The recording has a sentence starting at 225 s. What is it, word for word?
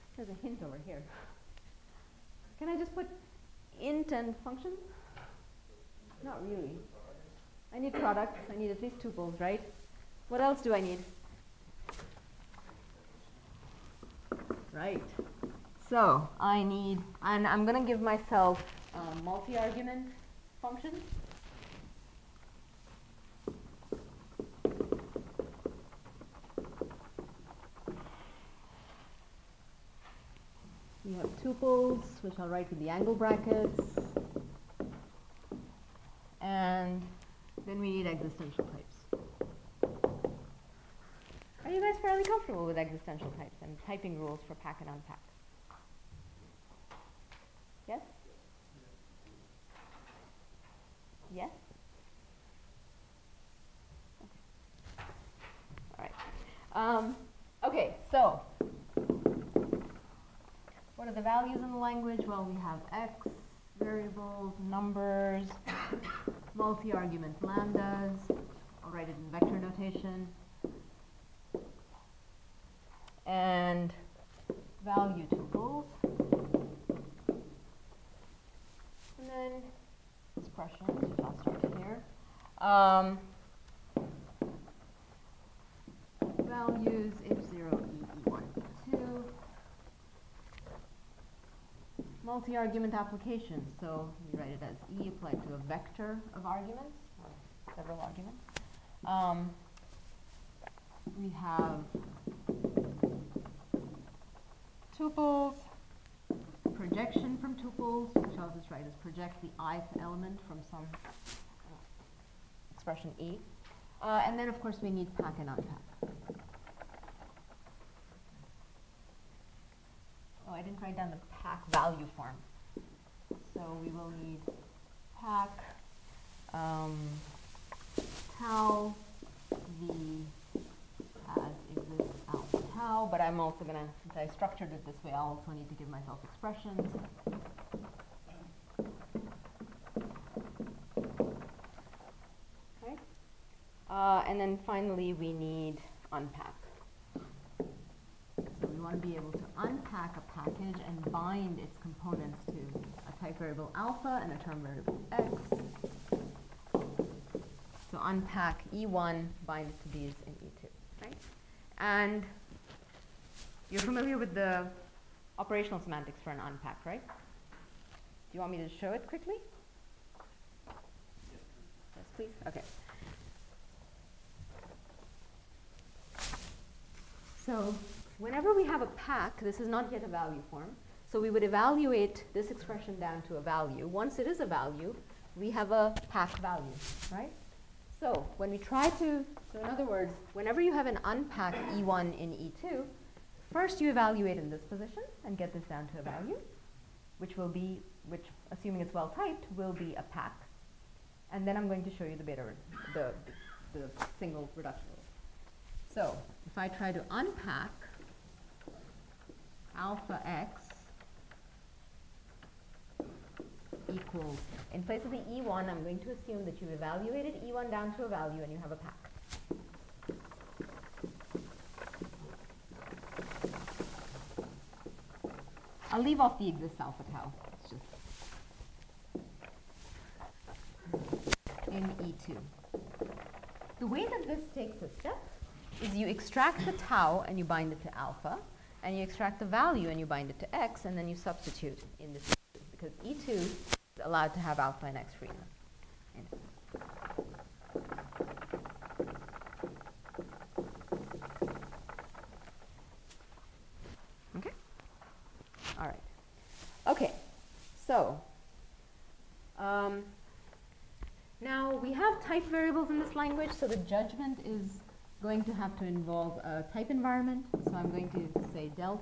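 I'll leave off the exists alpha tau.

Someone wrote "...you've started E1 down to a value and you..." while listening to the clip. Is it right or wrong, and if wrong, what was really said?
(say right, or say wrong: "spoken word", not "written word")
wrong: "evaluated", not "started".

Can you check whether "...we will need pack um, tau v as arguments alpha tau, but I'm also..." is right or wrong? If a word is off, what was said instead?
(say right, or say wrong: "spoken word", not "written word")
wrong: "exists", not "arguments".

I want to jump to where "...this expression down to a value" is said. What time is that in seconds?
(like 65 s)
182 s.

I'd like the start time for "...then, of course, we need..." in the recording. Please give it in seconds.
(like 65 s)
114 s.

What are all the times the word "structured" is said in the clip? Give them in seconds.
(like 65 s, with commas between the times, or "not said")
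134 s.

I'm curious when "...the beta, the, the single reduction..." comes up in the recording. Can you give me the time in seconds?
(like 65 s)
202 s.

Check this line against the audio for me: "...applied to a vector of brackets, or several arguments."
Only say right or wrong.
wrong.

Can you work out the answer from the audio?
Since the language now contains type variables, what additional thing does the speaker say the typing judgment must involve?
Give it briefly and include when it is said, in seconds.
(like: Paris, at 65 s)
a type environment, at 266 s.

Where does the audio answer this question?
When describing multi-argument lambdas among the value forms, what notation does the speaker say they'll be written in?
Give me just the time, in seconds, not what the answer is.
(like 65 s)
69 s.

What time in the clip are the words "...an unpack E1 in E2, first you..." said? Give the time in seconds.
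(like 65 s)
190 s.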